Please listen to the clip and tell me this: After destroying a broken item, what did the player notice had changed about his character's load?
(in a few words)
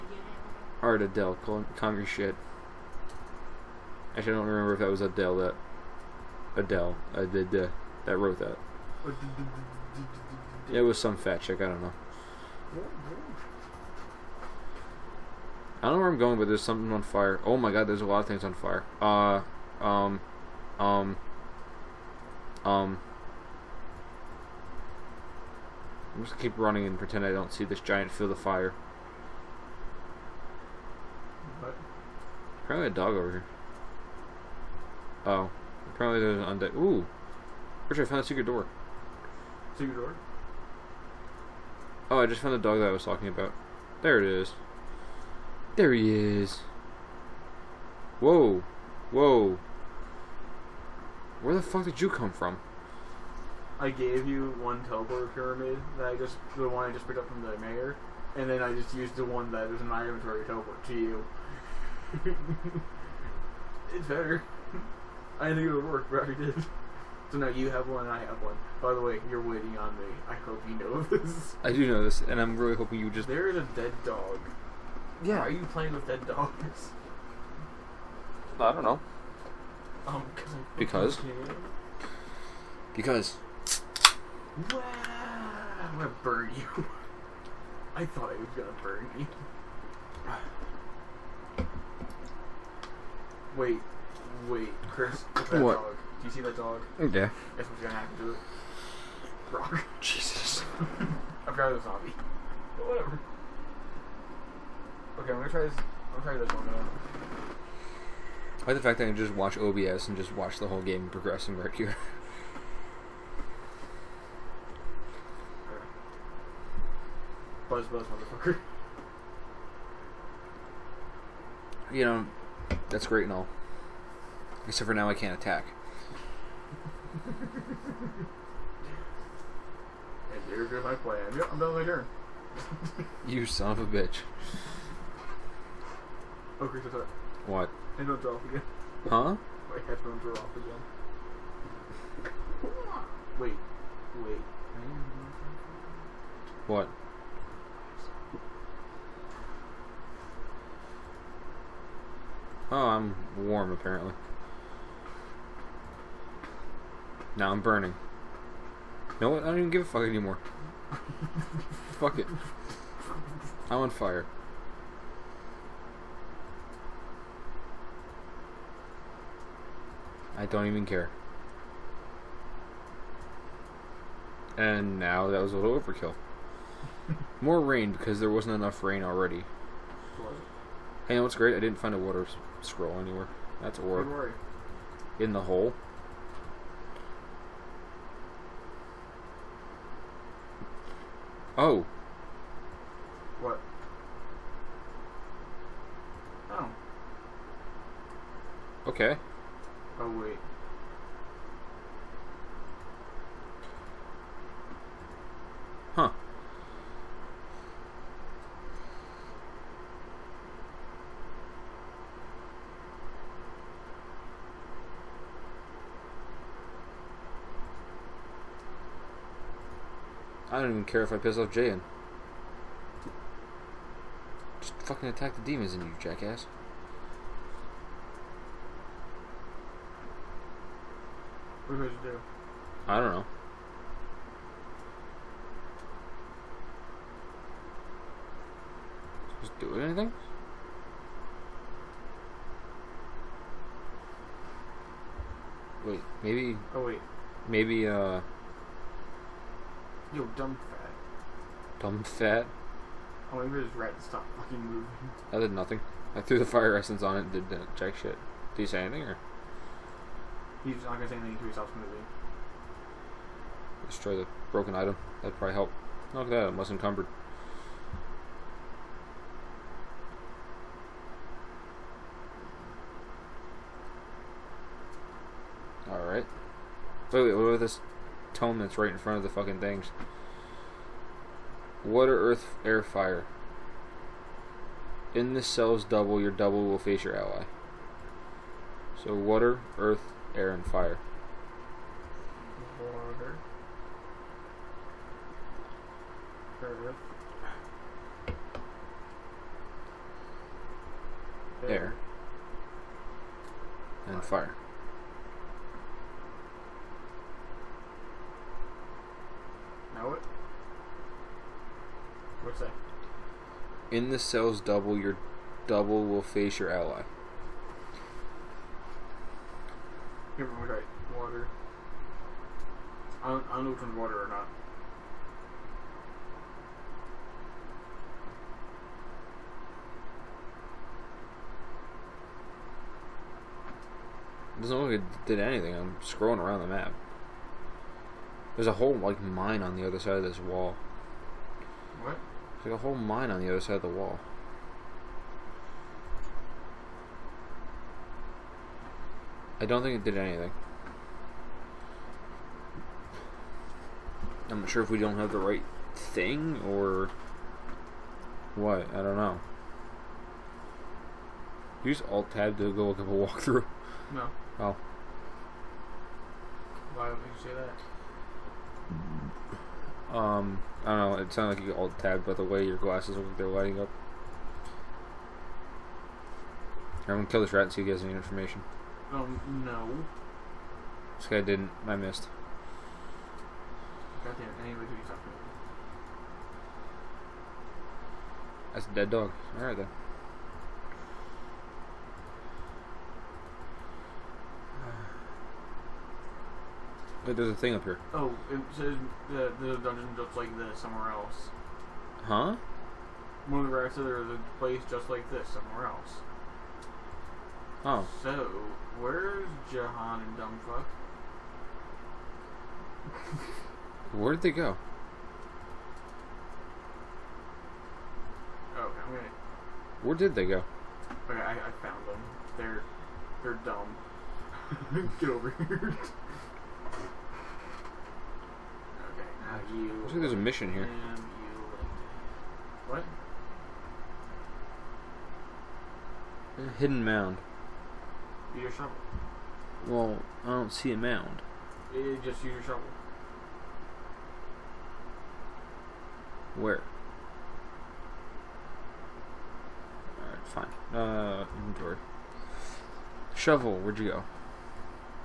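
Less encumbered.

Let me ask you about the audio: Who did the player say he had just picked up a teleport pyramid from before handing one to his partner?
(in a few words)
The mayor.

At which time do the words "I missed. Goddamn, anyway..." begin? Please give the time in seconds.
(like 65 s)
381 s.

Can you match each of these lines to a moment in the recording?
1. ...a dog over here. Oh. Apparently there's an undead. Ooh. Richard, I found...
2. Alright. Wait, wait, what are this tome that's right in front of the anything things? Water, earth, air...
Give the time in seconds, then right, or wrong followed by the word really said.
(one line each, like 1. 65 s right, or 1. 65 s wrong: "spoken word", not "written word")
1. 32 s right
2. 275 s wrong: "fucking", not "anything".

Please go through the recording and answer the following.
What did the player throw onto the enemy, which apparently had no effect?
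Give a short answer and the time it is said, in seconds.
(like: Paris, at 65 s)
Fire essence, at 256 s.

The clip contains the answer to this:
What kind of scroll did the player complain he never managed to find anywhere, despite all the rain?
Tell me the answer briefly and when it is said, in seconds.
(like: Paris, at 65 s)
Water scroll, at 181 s.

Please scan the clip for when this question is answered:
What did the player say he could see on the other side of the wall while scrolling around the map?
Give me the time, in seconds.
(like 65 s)
342 s.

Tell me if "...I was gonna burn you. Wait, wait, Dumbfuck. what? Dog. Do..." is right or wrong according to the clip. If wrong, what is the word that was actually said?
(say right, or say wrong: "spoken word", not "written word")
wrong: "Chris", not "Dumbfuck".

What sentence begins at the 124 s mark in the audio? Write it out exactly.
Except for now I can't attack.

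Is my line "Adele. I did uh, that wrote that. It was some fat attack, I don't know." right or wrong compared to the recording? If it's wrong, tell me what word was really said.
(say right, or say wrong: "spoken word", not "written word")
wrong: "chick", not "attack".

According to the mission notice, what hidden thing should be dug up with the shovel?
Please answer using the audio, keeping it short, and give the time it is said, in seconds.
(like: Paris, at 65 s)
A hidden mound, at 436 s.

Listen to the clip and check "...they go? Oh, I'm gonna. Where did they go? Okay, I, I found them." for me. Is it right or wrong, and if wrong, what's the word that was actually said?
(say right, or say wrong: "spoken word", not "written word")
right.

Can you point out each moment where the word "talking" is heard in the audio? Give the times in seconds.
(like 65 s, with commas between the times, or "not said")
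43 s, 385 s.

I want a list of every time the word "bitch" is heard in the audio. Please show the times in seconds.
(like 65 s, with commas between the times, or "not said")
133 s.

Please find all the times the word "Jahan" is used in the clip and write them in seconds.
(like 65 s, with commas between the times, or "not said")
221 s, 409 s.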